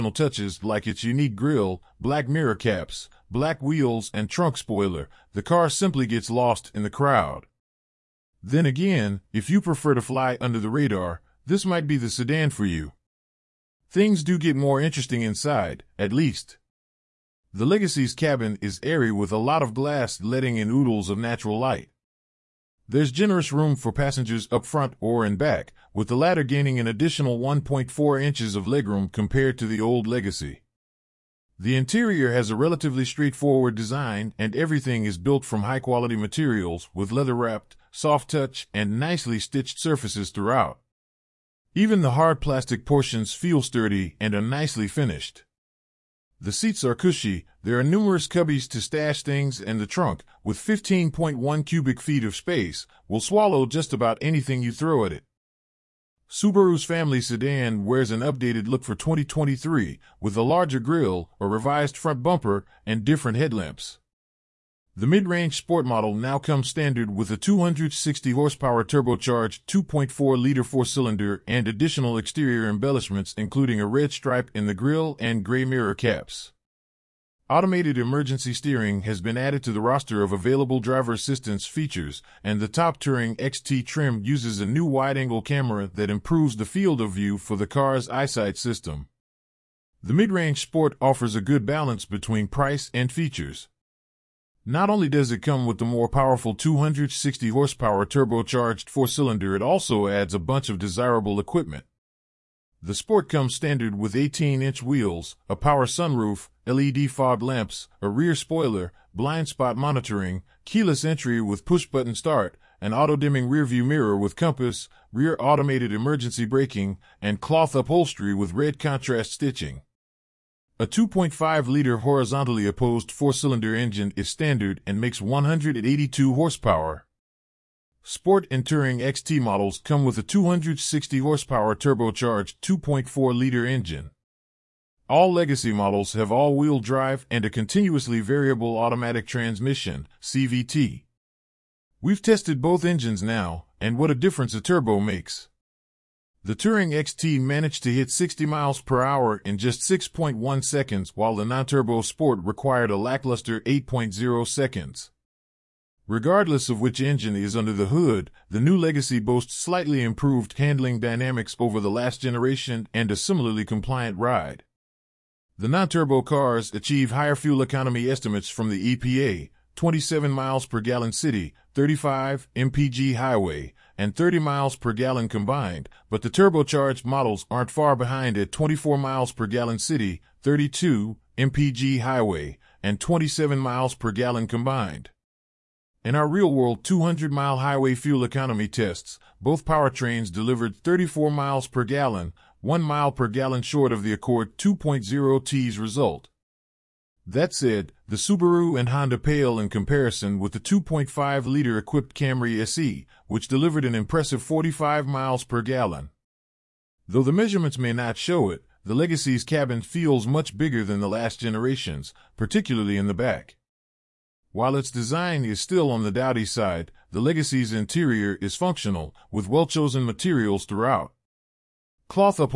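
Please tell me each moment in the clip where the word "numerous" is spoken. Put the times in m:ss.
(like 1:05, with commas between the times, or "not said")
0:47.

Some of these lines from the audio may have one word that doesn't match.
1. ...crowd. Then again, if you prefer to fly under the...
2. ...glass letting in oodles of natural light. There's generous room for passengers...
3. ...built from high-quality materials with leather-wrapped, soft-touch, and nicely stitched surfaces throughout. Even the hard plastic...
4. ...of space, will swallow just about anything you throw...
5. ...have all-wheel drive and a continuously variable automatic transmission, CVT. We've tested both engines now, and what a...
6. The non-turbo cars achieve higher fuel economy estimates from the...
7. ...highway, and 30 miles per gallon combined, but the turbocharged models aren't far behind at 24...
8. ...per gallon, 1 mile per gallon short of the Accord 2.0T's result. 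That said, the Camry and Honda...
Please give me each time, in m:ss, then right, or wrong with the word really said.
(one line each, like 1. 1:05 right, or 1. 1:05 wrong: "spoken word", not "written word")
1. 0:06 right
2. 0:19 right
3. 0:35 right
4. 0:52 right
5. 2:16 right
6. 2:45 right
7. 2:53 right
8. 3:11 wrong: "Subaru", not "Camry".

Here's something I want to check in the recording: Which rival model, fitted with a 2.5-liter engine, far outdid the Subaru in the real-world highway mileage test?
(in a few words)
Camry SE.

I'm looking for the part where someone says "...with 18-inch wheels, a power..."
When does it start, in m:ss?
1:43.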